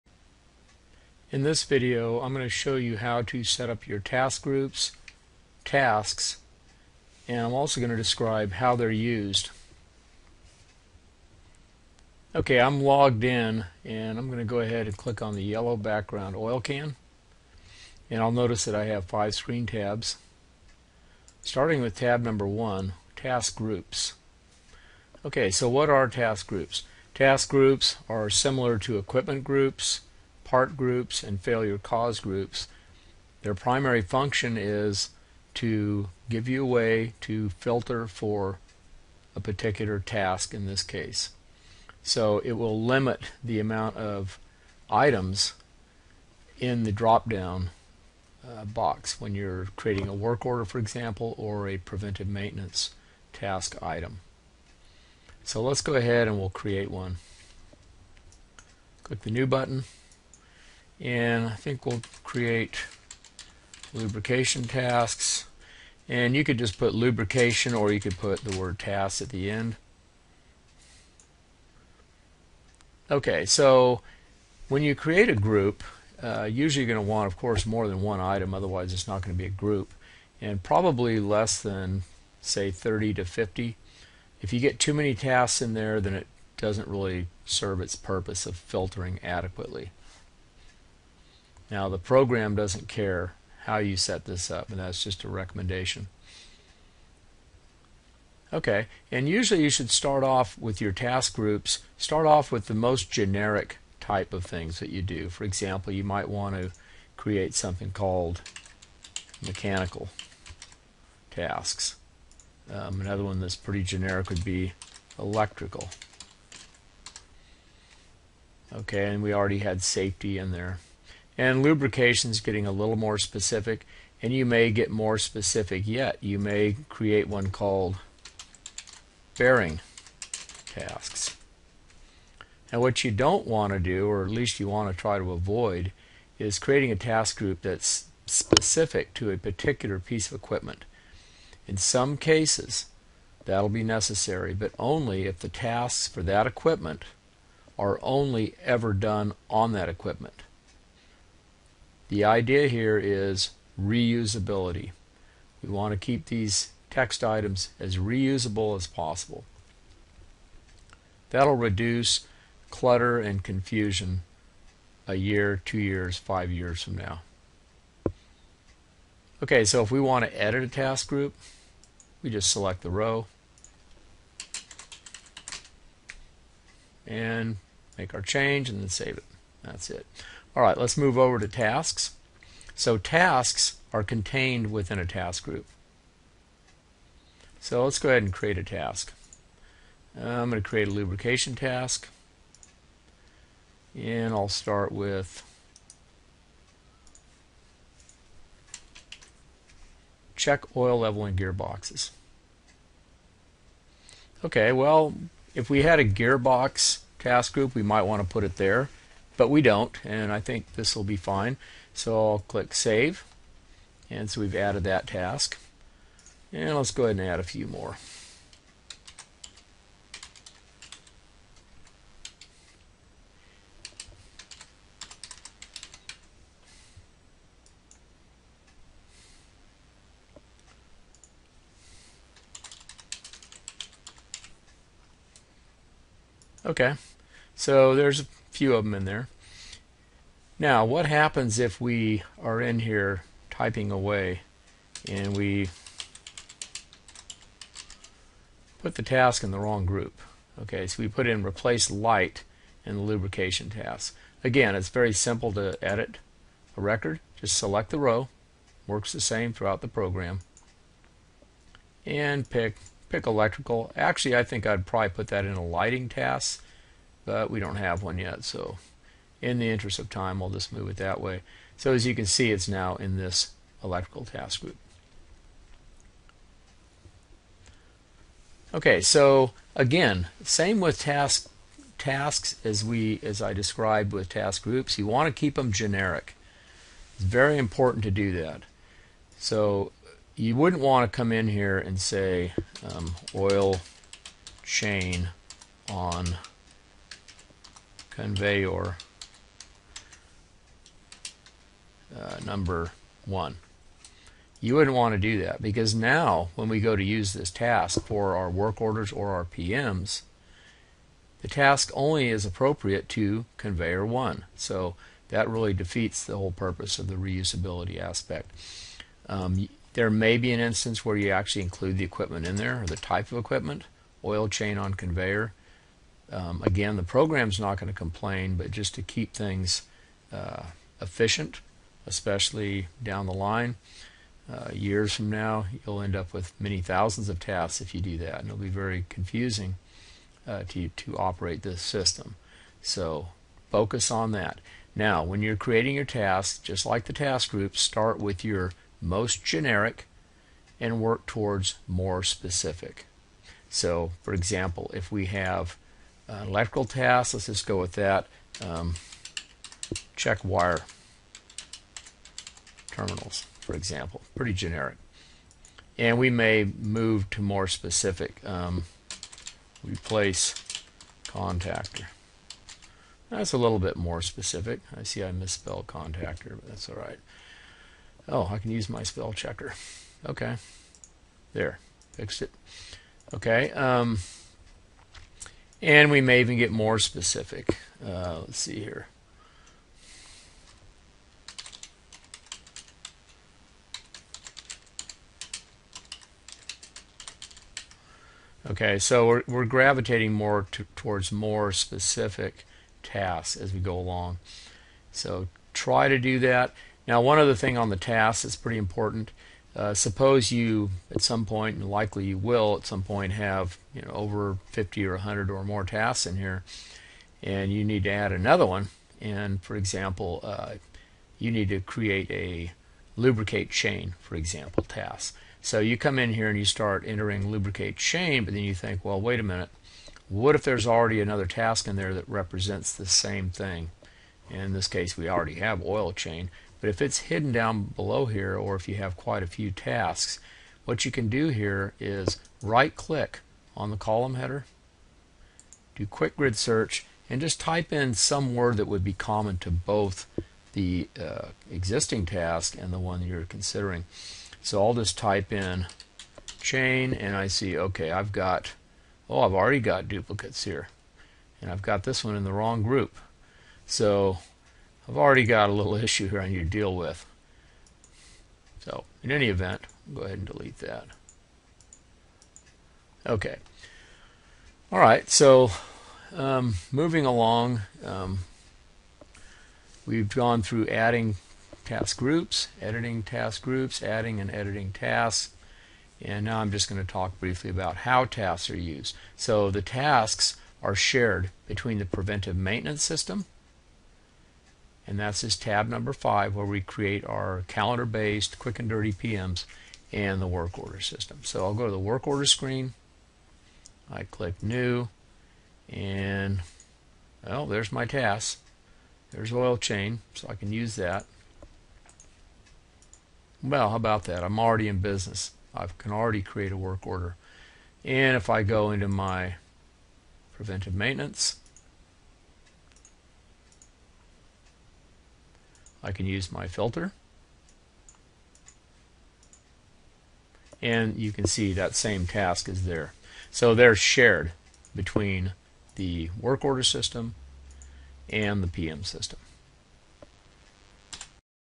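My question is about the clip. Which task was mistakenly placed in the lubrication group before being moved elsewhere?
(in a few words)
replace light.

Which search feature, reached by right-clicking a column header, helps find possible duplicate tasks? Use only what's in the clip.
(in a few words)
quick grid search.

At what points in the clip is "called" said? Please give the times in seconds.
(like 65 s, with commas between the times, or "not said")
107 s, 127 s.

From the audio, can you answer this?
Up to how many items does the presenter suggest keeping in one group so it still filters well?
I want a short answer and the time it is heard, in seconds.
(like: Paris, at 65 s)
30 to 50, at 82 s.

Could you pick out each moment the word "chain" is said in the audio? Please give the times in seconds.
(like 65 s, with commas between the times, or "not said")
294 s, 324 s, 423 s, 427 s, 436 s, 456 s, 509 s.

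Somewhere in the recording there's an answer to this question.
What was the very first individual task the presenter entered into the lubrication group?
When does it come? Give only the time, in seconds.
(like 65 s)
200 s.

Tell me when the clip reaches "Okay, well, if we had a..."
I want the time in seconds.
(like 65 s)
204 s.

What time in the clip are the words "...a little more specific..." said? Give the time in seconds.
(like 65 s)
122 s.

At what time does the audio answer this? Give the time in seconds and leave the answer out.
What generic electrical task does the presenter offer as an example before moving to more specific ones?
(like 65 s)
360 s.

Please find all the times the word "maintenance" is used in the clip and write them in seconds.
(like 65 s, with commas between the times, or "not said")
52 s, 492 s, 520 s.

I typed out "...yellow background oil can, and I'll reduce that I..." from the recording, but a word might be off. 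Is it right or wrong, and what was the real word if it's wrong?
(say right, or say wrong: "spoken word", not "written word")
wrong: "notice", not "reduce".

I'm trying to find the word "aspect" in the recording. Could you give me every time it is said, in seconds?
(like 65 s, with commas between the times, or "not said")
317 s.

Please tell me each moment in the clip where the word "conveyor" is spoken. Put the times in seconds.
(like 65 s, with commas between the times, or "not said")
298 s, 313 s, 324 s.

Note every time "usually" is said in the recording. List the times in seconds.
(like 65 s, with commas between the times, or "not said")
76 s, 99 s.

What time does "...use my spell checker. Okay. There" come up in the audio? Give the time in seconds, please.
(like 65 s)
378 s.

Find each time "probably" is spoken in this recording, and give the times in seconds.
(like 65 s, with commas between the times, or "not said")
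80 s, 264 s.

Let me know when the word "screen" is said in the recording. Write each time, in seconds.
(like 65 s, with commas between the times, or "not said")
19 s, 502 s.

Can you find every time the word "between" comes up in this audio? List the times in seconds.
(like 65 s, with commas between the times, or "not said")
491 s, 534 s.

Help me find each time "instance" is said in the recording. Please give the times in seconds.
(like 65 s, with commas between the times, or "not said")
320 s.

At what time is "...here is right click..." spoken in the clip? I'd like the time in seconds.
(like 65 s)
441 s.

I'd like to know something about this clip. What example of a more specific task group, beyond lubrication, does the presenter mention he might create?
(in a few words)
bearing tasks.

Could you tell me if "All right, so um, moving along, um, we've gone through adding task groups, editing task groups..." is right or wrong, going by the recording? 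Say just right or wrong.
right.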